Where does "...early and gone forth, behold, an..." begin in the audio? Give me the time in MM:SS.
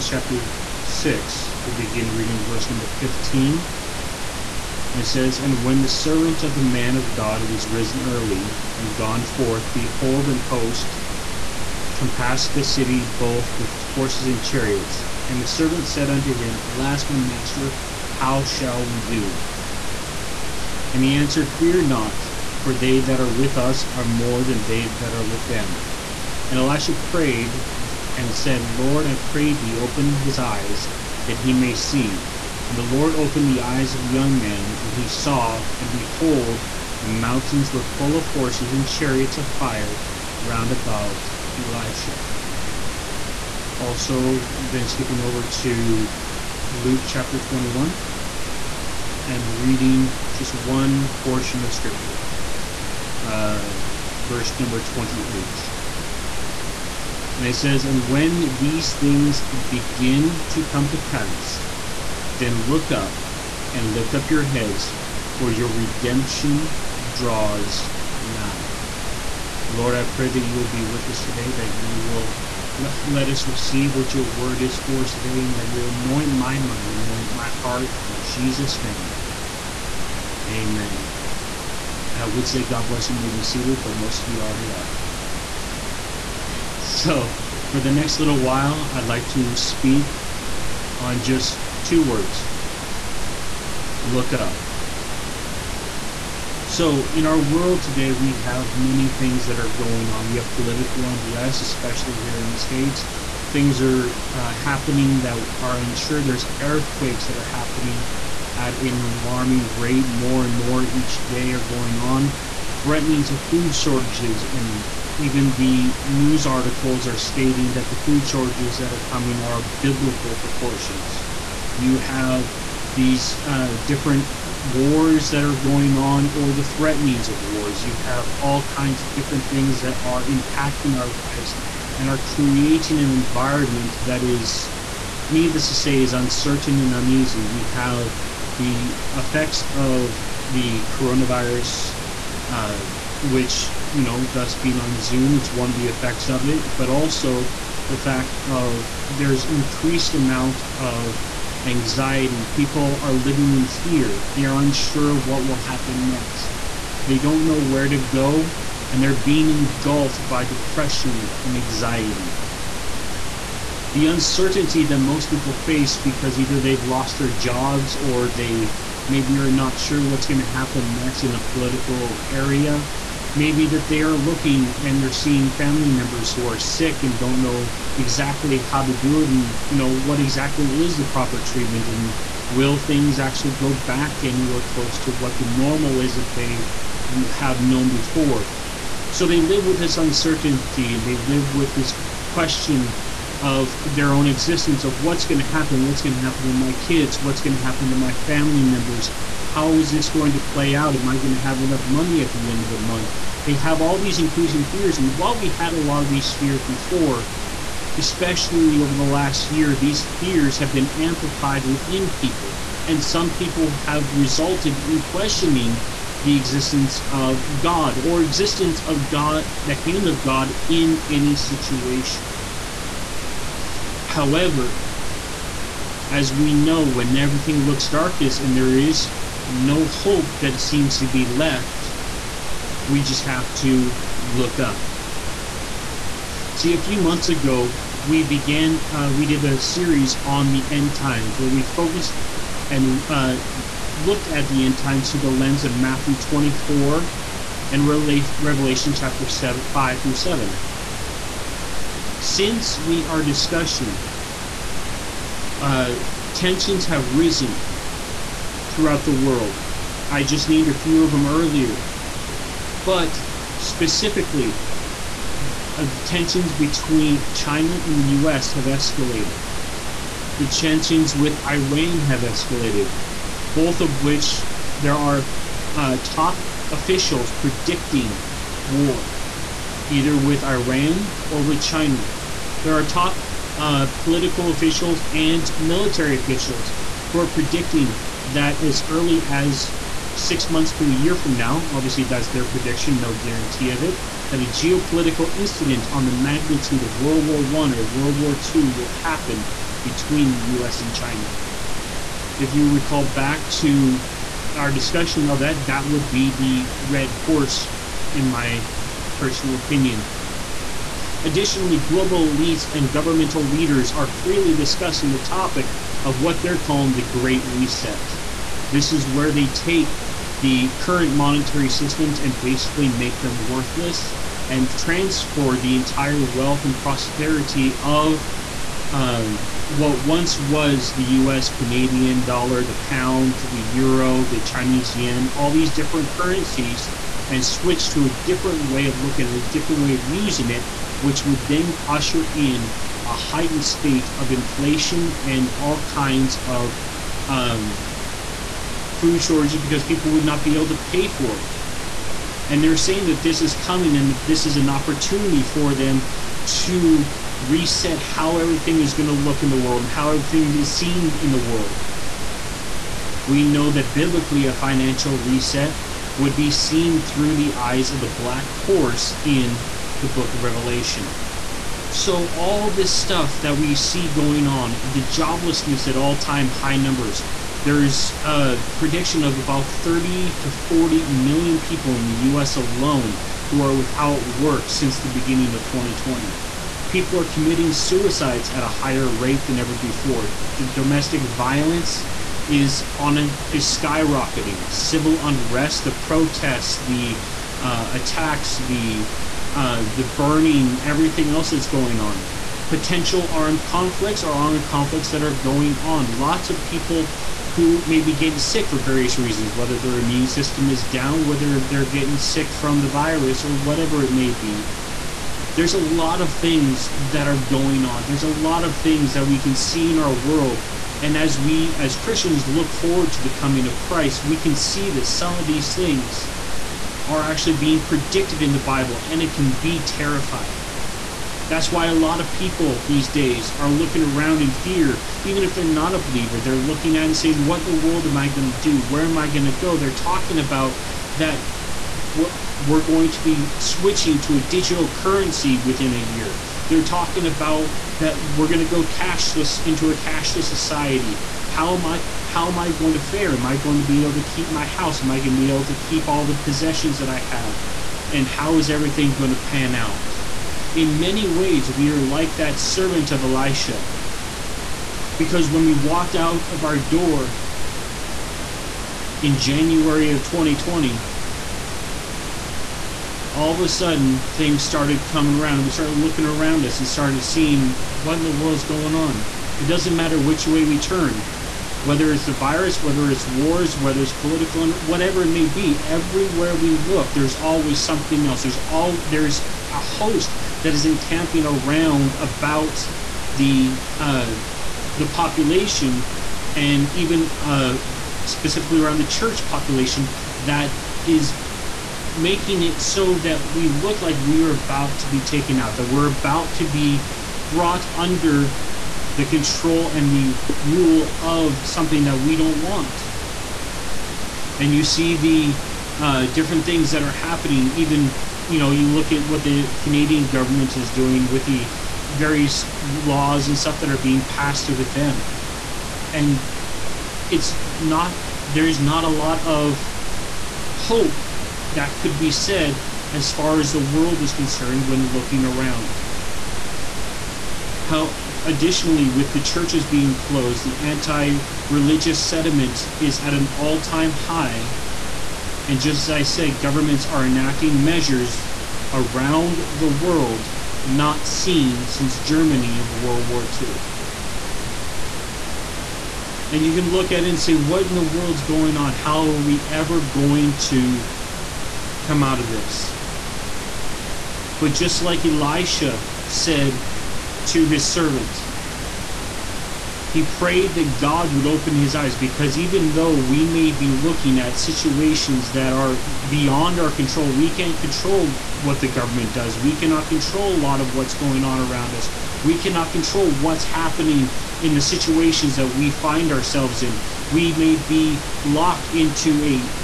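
00:08.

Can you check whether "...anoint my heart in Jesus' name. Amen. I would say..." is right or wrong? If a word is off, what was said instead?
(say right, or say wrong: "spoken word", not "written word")
right.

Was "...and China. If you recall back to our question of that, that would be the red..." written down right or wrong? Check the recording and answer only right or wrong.
wrong.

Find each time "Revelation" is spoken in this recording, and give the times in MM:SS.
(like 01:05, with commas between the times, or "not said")
04:08, 06:10.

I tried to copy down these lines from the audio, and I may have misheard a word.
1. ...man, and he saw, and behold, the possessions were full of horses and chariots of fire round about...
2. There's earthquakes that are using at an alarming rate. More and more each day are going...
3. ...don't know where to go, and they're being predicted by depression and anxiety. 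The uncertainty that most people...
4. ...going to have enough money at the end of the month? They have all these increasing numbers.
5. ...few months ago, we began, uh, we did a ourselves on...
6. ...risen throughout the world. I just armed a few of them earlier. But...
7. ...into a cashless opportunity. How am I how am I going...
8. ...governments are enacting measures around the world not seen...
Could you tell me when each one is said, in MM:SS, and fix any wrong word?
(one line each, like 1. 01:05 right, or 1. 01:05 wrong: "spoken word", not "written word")
1. 00:34 wrong: "mountains", not "possessions"
2. 01:46 wrong: "happening", not "using"
3. 02:37 wrong: "engulfed", not "predicted"
4. 03:21 wrong: "fears", not "numbers"
5. 03:56 wrong: "series", not "ourselves"
6. 04:17 wrong: "named", not "armed"
7. 07:29 wrong: "society", not "opportunity"
8. 09:06 right.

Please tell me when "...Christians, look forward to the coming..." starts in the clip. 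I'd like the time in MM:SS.
07:01.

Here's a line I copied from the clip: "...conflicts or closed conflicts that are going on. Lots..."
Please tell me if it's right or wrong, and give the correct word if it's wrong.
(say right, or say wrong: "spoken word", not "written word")
wrong: "armed", not "closed".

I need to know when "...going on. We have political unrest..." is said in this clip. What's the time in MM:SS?
01:39.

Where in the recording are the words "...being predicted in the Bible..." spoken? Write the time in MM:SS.
07:07.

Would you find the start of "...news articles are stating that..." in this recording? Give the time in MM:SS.
01:56.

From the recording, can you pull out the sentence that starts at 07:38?
And how is everything going to pan out?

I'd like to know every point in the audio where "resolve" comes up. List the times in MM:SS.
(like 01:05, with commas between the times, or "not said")
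not said.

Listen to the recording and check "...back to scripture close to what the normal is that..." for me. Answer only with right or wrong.
wrong.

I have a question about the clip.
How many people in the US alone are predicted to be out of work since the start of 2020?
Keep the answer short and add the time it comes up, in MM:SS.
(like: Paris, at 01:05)
30 to 40 million, at 06:19.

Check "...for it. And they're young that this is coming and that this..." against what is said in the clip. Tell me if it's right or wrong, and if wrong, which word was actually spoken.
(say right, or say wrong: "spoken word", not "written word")
wrong: "saying", not "young".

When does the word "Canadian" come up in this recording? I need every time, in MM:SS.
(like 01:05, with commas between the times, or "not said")
05:31, 08:39.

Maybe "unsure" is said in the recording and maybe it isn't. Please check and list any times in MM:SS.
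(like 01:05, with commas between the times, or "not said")
01:45, 02:34.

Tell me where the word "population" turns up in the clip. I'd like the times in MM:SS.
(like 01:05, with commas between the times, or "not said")
08:15, 08:19.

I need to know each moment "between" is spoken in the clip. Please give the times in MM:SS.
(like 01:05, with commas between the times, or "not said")
04:26, 04:59.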